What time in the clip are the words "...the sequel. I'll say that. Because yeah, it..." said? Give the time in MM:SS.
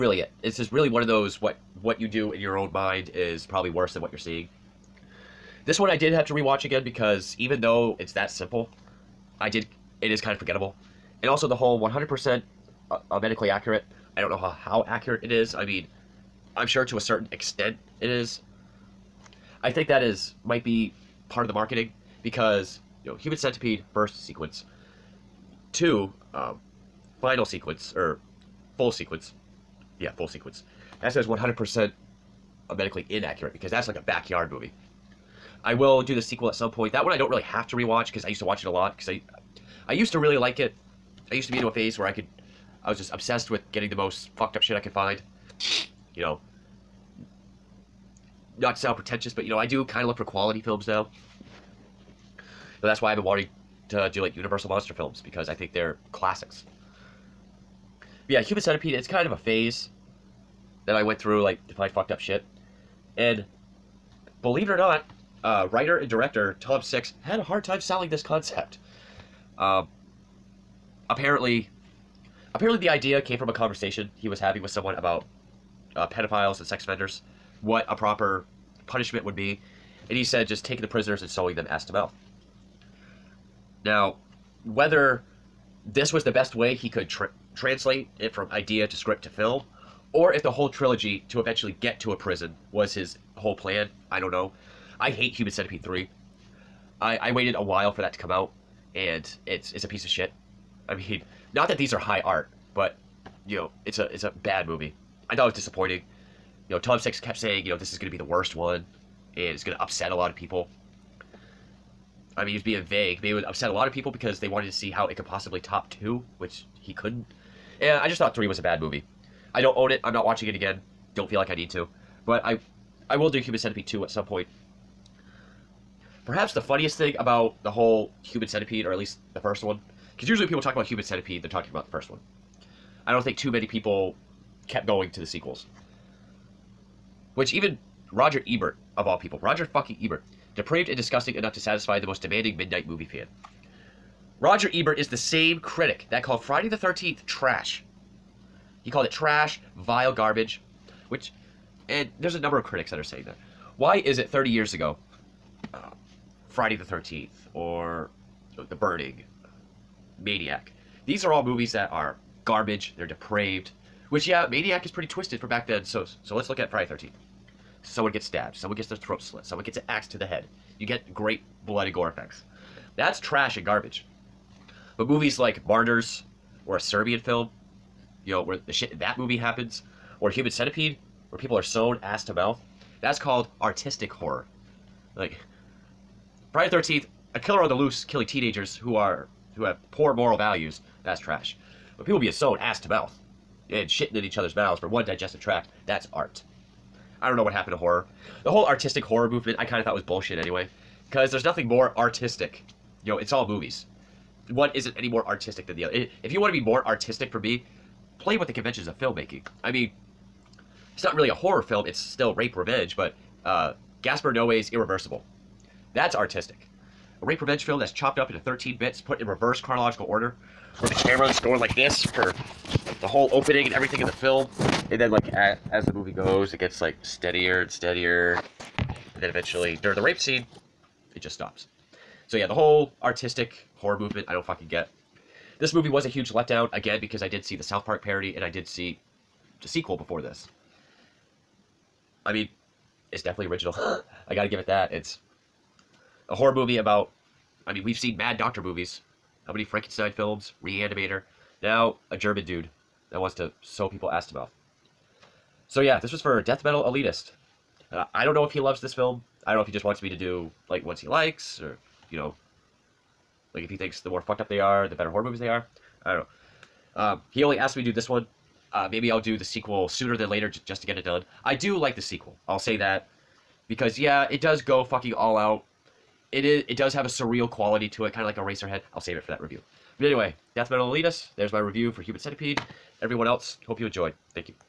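04:31.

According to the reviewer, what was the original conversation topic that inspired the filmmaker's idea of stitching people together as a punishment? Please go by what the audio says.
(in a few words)
pedophiles and sex offenders.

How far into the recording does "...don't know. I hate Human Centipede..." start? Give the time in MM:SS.
01:34.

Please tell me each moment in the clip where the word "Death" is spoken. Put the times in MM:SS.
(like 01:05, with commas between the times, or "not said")
04:16, 04:40.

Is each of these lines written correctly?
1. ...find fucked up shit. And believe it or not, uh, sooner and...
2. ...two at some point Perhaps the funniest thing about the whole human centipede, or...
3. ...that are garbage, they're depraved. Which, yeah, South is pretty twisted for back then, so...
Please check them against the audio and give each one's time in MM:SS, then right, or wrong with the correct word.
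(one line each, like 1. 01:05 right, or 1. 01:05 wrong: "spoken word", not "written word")
1. 01:01 wrong: "writer", not "sooner"
2. 02:03 right
3. 02:41 wrong: "Maniac", not "South".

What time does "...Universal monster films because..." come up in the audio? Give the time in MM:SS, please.
00:54.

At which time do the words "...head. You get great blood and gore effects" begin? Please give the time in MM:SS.
02:50.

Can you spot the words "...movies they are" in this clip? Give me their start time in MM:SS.
04:25.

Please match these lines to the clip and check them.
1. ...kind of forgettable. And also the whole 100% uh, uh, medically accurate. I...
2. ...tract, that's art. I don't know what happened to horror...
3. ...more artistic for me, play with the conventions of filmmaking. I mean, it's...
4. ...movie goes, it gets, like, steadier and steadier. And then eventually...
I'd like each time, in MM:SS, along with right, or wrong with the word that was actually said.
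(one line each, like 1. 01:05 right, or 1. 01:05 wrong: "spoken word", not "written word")
1. 00:10 right
2. 03:15 right
3. 03:26 right
4. 03:45 right.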